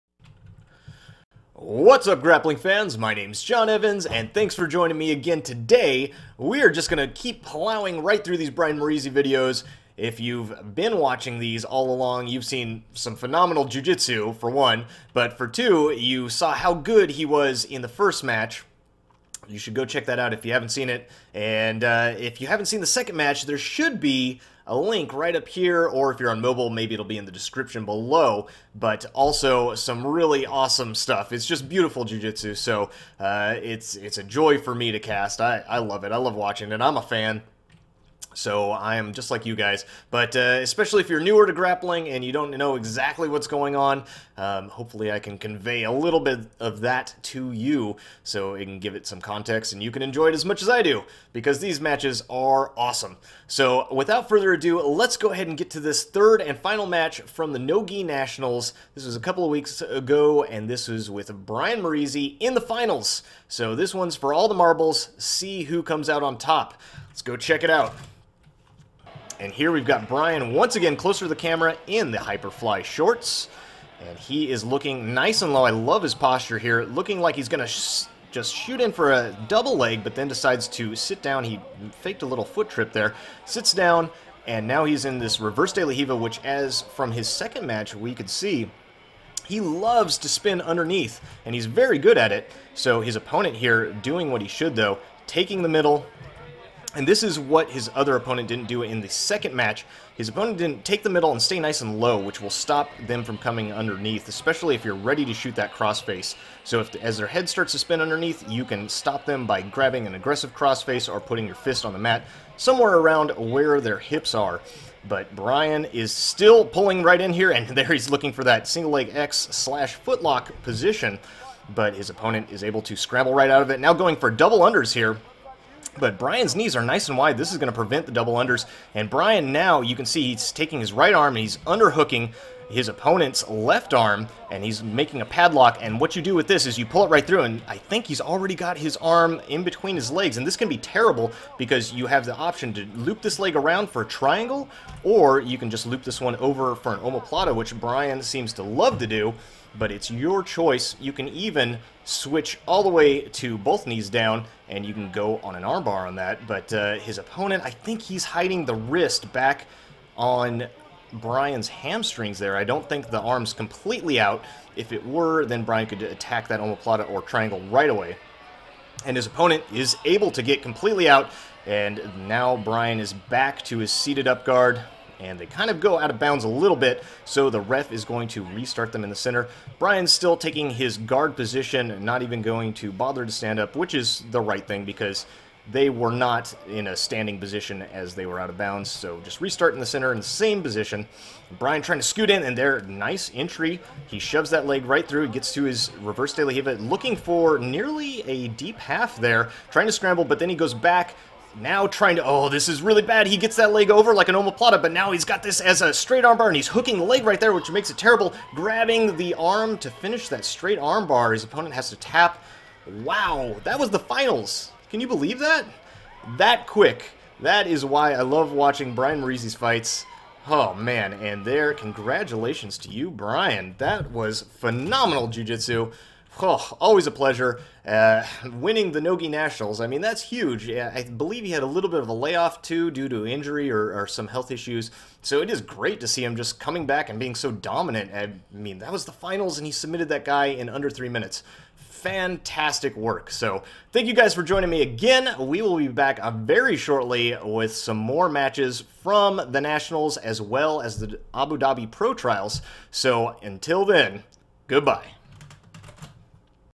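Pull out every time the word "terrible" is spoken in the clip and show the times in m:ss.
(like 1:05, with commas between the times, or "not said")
2:20, 3:27.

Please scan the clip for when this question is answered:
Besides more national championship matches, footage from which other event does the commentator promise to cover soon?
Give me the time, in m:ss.
4:11.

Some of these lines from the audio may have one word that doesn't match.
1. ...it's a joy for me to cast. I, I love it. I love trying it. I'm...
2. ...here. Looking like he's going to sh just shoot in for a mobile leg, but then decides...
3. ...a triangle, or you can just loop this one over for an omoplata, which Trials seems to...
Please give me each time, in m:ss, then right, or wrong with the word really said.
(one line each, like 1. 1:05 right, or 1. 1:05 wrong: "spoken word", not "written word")
1. 0:33 wrong: "watching", not "trying"
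2. 1:16 wrong: "double", not "mobile"
3. 2:24 wrong: "Brian", not "Trials".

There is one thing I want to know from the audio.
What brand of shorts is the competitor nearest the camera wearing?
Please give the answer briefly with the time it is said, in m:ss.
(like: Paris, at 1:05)
Hyperfly, at 1:12.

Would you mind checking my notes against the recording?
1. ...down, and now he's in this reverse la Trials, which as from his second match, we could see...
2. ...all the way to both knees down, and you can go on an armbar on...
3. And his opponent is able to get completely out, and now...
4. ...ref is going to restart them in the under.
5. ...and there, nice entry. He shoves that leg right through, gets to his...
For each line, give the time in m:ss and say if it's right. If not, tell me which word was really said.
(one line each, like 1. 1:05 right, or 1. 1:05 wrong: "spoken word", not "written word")
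1. 1:23 wrong: "Riva", not "Trials"
2. 2:32 right
3. 2:49 right
4. 2:57 wrong: "center", not "under"
5. 3:12 right.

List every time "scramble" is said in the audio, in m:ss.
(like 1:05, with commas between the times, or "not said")
2:02, 3:19.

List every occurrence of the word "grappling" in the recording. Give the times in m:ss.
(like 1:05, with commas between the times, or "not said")
0:02, 0:41.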